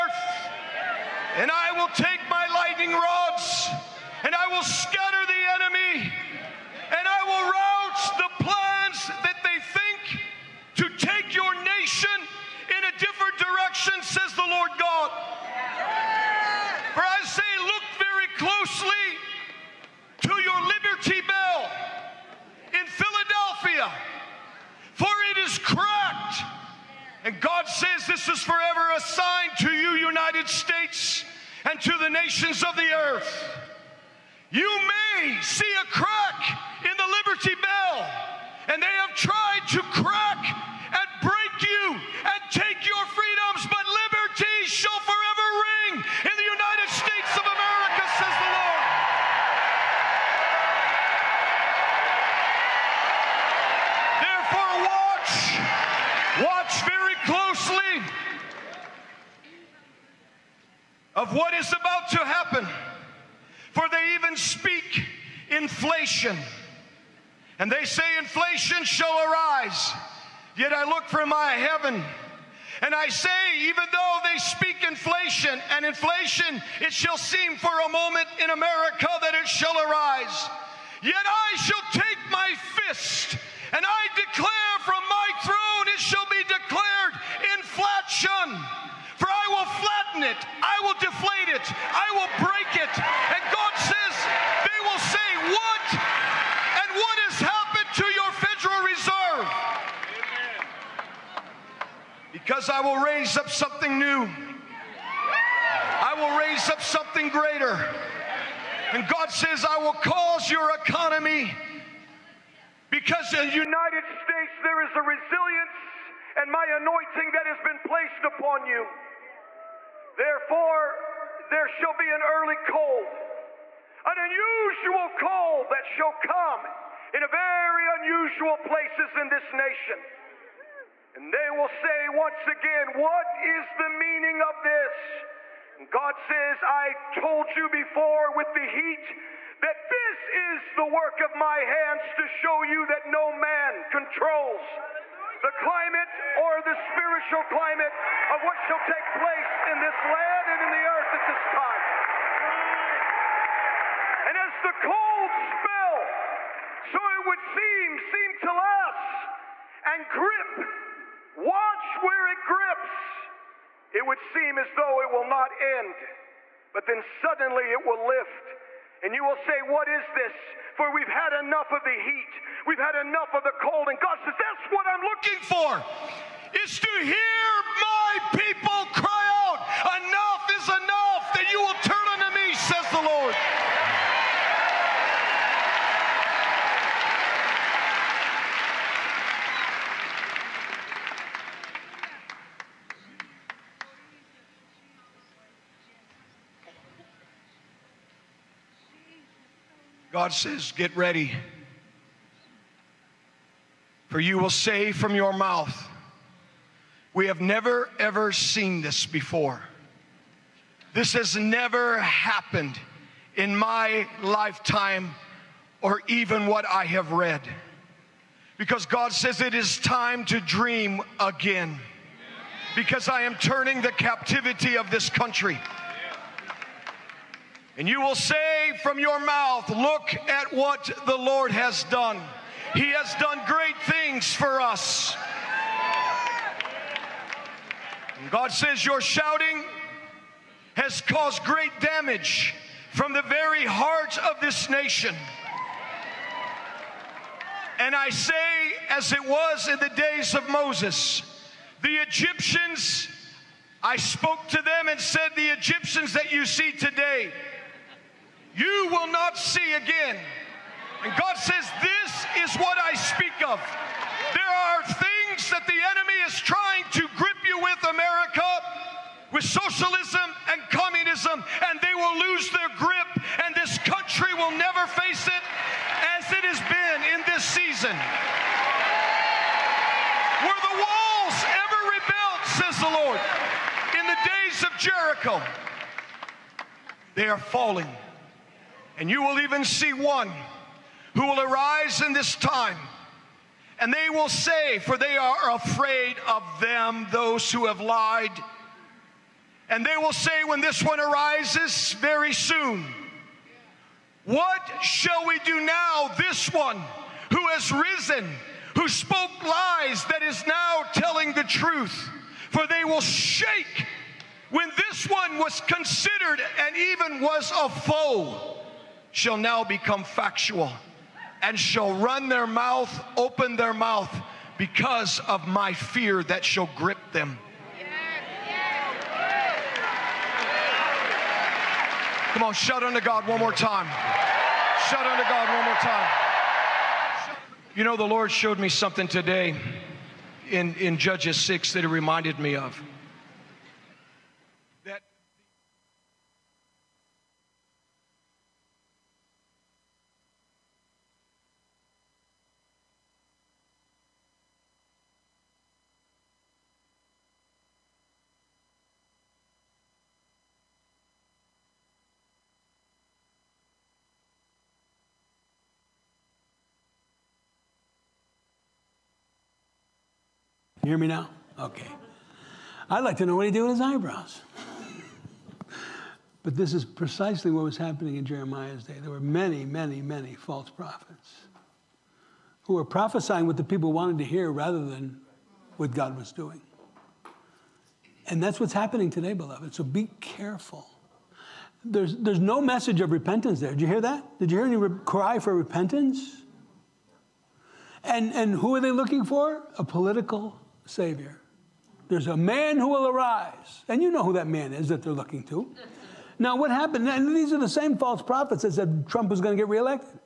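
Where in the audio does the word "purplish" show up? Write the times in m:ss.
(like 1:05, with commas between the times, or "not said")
not said.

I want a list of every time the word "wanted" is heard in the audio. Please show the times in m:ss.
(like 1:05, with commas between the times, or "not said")
6:23.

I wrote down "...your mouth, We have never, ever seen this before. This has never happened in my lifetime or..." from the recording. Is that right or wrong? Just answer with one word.
right.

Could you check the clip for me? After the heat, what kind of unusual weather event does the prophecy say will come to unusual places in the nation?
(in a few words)
an early cold.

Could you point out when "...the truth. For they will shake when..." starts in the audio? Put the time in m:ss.
5:11.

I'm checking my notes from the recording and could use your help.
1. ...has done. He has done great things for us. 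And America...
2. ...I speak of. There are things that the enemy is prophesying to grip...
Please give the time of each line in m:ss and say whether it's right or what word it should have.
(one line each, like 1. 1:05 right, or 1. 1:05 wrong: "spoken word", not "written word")
1. 3:51 wrong: "God", not "America"
2. 4:22 wrong: "trying", not "prophesying".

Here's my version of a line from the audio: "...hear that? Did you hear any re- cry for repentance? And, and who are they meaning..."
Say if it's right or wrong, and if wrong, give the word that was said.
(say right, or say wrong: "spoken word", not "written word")
wrong: "looking", not "meaning".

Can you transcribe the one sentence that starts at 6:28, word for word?
And that's what's happening today, beloved.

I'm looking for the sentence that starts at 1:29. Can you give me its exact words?
For I will flatten it, I will deflate it, I will break it.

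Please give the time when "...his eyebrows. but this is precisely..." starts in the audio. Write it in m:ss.
6:13.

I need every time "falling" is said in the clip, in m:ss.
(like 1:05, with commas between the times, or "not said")
4:47.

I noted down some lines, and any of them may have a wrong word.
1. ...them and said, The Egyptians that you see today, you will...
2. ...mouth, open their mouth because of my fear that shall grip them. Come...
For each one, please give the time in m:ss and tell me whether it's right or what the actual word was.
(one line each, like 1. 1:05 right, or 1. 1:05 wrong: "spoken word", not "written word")
1. 4:14 right
2. 5:22 right.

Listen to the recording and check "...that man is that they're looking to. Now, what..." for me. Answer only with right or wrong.
right.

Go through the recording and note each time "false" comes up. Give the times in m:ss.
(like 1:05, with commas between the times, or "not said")
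6:20, 6:47.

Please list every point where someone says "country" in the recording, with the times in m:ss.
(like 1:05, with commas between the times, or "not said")
3:45, 4:33.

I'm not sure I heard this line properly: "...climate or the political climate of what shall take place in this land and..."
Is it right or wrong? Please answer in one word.
wrong.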